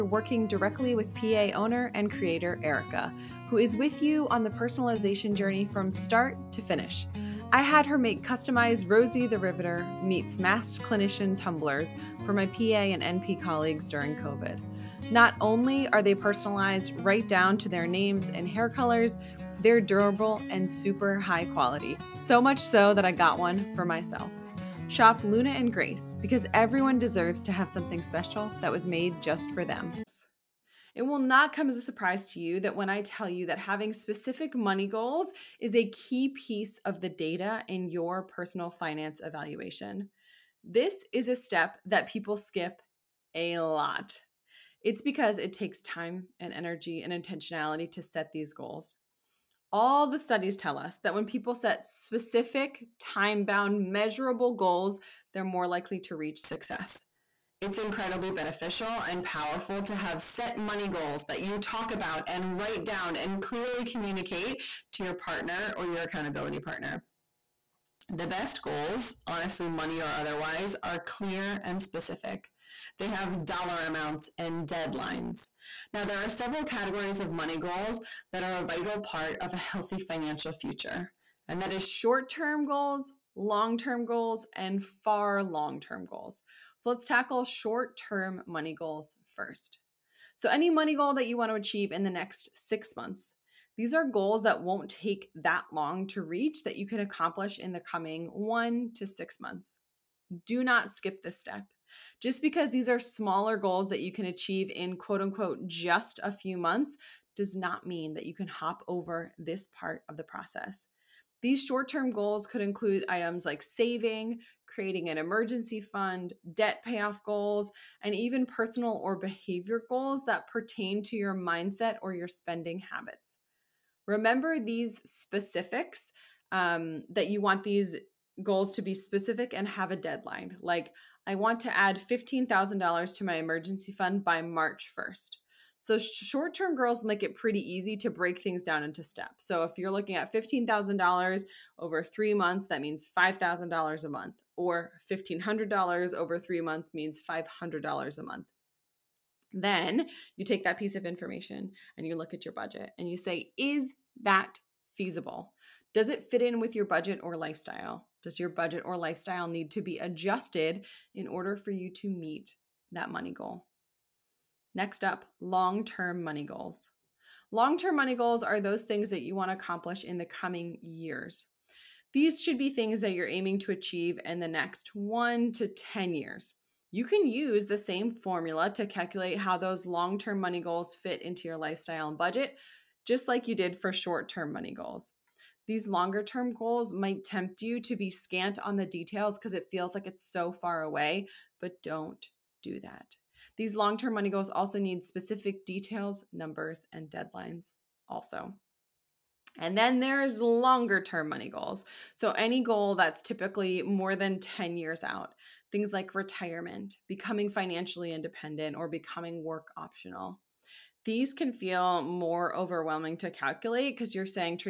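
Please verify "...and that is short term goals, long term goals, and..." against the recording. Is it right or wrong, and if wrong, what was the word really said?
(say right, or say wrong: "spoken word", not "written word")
right.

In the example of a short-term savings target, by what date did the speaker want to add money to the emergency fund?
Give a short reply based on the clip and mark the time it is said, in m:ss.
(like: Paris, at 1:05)
March 1st, at 2:14.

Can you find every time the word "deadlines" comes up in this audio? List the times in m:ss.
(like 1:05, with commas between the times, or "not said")
1:14, 2:09, 3:17.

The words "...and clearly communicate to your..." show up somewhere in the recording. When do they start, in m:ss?
1:03.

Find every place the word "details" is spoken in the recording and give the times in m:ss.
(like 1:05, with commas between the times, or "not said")
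3:08, 3:15.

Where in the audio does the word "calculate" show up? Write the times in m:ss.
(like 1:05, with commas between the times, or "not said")
2:58, 3:33.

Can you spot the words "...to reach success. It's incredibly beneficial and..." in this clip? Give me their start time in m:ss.
0:55.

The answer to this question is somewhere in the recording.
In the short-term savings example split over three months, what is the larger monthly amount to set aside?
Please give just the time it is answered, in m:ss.
2:23.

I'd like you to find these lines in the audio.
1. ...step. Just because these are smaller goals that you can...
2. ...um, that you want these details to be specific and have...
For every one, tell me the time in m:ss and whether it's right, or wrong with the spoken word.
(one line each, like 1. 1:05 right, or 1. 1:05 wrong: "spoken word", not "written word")
1. 1:41 right
2. 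2:06 wrong: "goals", not "details".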